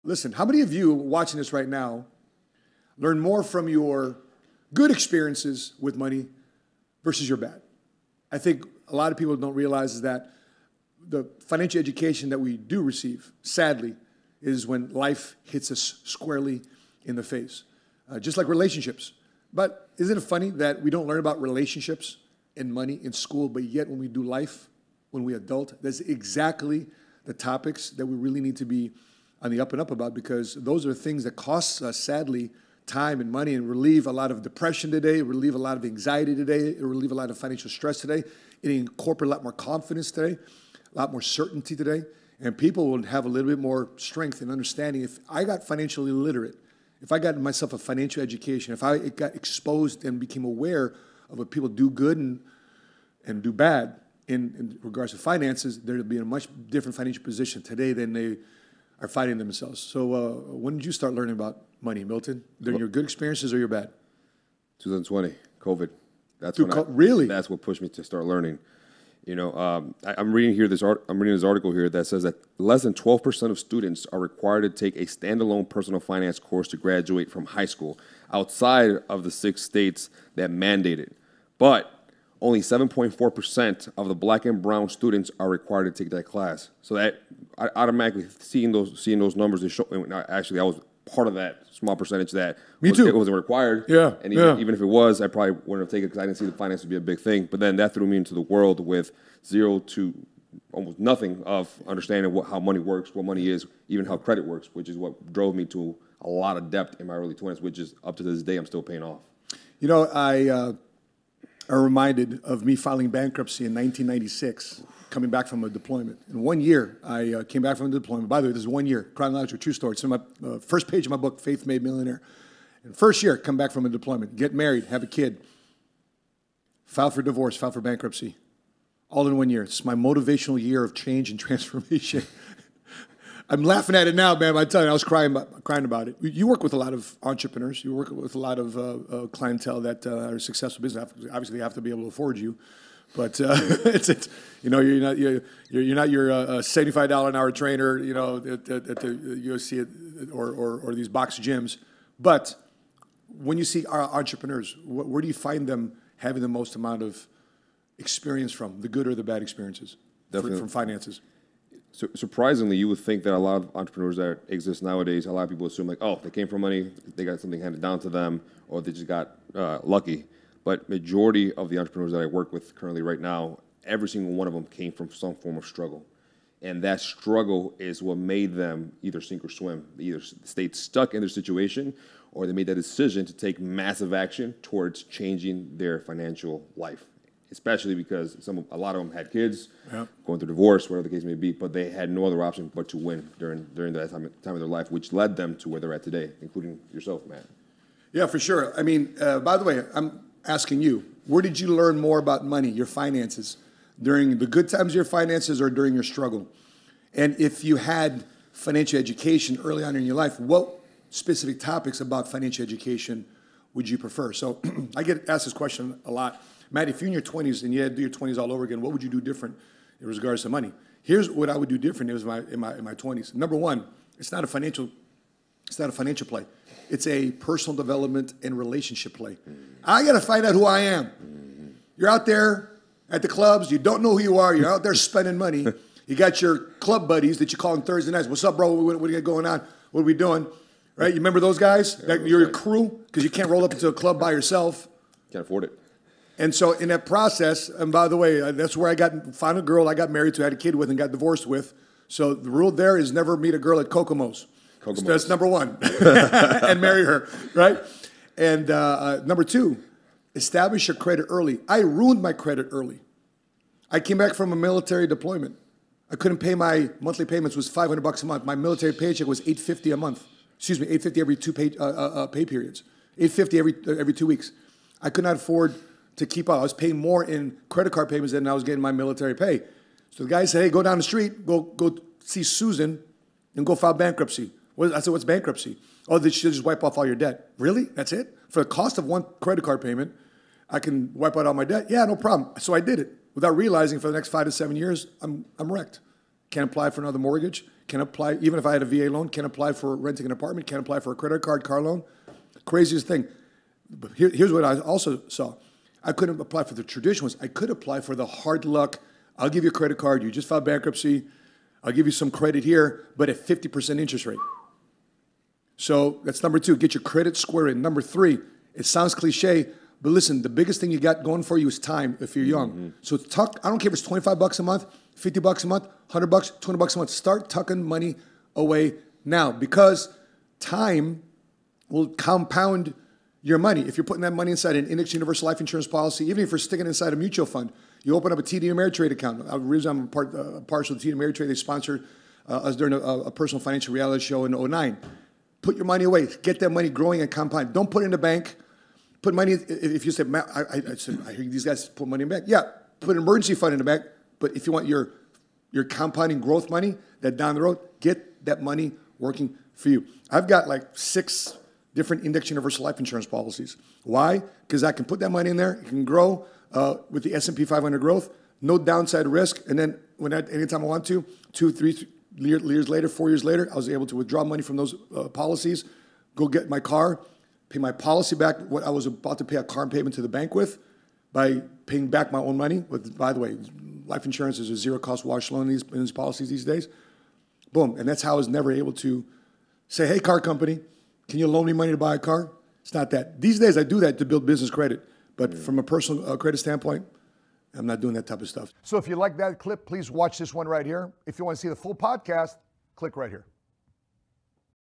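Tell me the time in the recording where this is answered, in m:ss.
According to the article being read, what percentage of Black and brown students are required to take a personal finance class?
1:22.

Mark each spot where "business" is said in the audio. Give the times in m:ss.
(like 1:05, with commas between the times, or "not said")
2:20, 6:34.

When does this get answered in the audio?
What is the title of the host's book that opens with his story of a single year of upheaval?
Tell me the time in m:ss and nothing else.
2:01.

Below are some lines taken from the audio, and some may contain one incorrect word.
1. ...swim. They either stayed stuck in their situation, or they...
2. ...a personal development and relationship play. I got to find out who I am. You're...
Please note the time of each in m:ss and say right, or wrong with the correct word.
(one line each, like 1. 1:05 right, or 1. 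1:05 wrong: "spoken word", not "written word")
1. 2:59 right
2. 3:47 right.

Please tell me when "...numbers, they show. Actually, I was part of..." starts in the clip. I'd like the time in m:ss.
1:29.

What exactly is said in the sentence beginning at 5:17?
Number three, it sounds cliche, but listen, the biggest thing you got going for you is time if you're young.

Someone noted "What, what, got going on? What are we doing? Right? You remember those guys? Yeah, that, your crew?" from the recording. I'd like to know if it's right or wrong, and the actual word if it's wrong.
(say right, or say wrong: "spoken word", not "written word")
right.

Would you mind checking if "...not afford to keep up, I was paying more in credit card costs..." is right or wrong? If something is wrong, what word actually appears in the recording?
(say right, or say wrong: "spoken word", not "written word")
wrong: "payments", not "costs".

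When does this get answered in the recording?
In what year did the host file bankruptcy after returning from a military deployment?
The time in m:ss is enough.
1:53.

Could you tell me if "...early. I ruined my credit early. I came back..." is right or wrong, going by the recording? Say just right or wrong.
right.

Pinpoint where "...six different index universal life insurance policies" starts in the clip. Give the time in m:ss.
6:00.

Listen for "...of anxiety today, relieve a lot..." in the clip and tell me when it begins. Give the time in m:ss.
0:35.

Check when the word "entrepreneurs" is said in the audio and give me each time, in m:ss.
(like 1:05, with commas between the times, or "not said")
2:17, 2:34, 2:43, 2:51.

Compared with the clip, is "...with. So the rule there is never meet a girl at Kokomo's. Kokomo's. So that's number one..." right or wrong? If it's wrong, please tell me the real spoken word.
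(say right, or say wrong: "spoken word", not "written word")
right.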